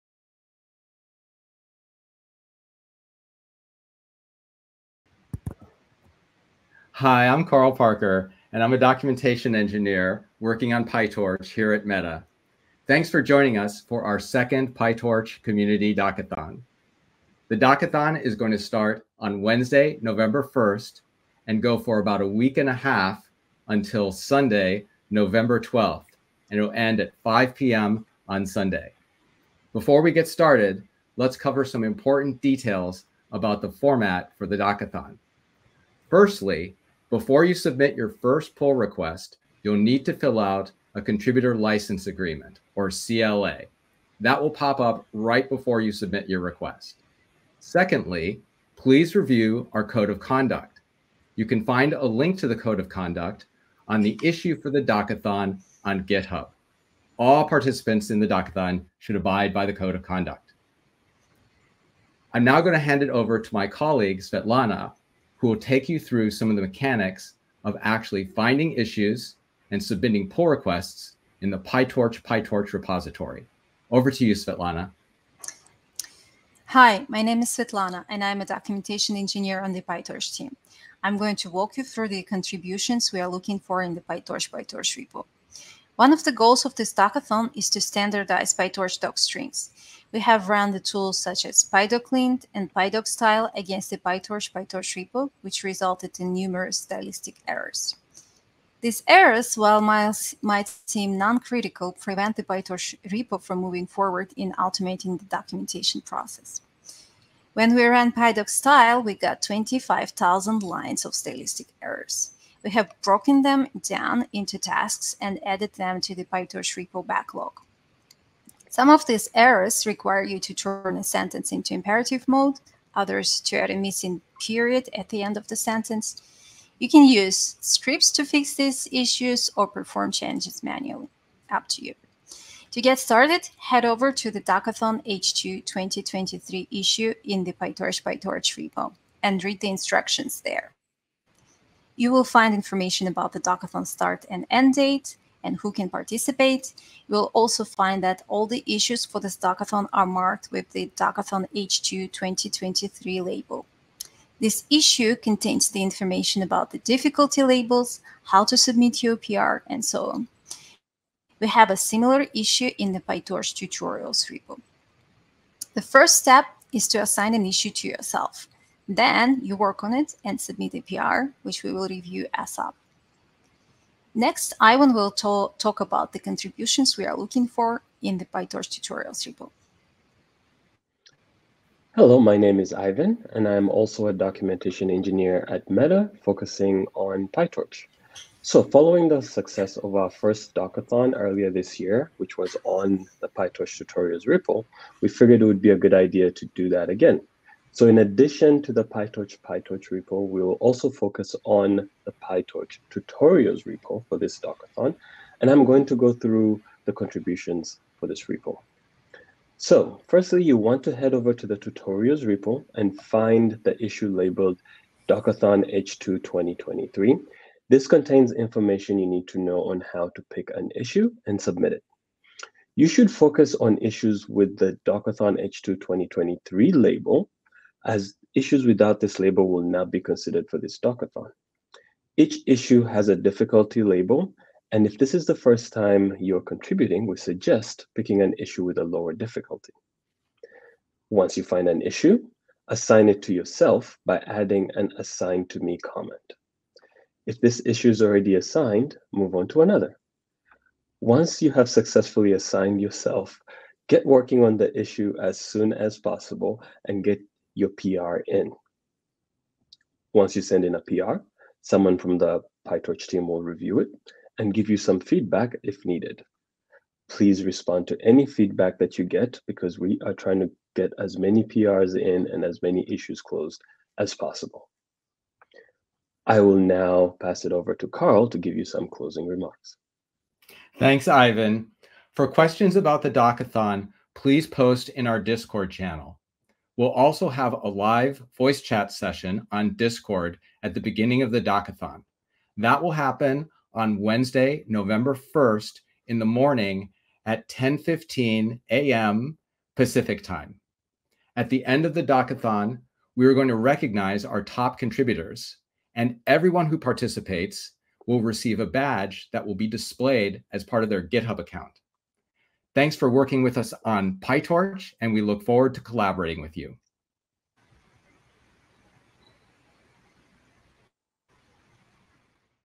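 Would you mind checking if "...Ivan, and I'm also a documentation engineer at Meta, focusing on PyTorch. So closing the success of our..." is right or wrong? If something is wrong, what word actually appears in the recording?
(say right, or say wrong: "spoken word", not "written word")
wrong: "following", not "closing".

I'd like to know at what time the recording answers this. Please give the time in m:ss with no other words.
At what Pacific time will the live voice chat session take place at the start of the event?
4:57.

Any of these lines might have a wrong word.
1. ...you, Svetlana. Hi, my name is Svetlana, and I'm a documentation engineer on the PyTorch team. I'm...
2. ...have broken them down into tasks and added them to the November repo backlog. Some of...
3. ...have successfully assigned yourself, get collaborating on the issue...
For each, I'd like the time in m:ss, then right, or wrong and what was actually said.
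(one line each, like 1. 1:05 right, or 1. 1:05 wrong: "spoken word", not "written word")
1. 1:14 right
2. 1:52 wrong: "PyTorch", not "November"
3. 4:11 wrong: "working", not "collaborating".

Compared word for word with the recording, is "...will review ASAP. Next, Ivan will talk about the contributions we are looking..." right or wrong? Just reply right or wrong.
right.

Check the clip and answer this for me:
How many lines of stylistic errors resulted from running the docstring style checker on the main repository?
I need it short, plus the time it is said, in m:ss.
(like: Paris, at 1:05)
25,000, at 1:49.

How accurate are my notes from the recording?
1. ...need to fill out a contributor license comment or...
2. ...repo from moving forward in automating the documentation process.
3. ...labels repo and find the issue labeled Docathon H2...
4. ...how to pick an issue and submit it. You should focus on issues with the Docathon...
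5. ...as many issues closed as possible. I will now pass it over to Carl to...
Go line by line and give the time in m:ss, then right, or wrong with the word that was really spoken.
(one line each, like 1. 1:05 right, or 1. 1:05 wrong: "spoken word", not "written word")
1. 0:39 wrong: "agreement", not "comment"
2. 1:43 right
3. 3:31 wrong: "tutorials", not "labels"
4. 3:39 right
5. 4:32 right.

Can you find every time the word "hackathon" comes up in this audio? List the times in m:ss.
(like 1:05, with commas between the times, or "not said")
1:26, 2:14.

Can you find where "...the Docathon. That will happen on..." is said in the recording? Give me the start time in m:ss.
4:51.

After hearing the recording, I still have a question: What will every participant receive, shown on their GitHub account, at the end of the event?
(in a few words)
badge.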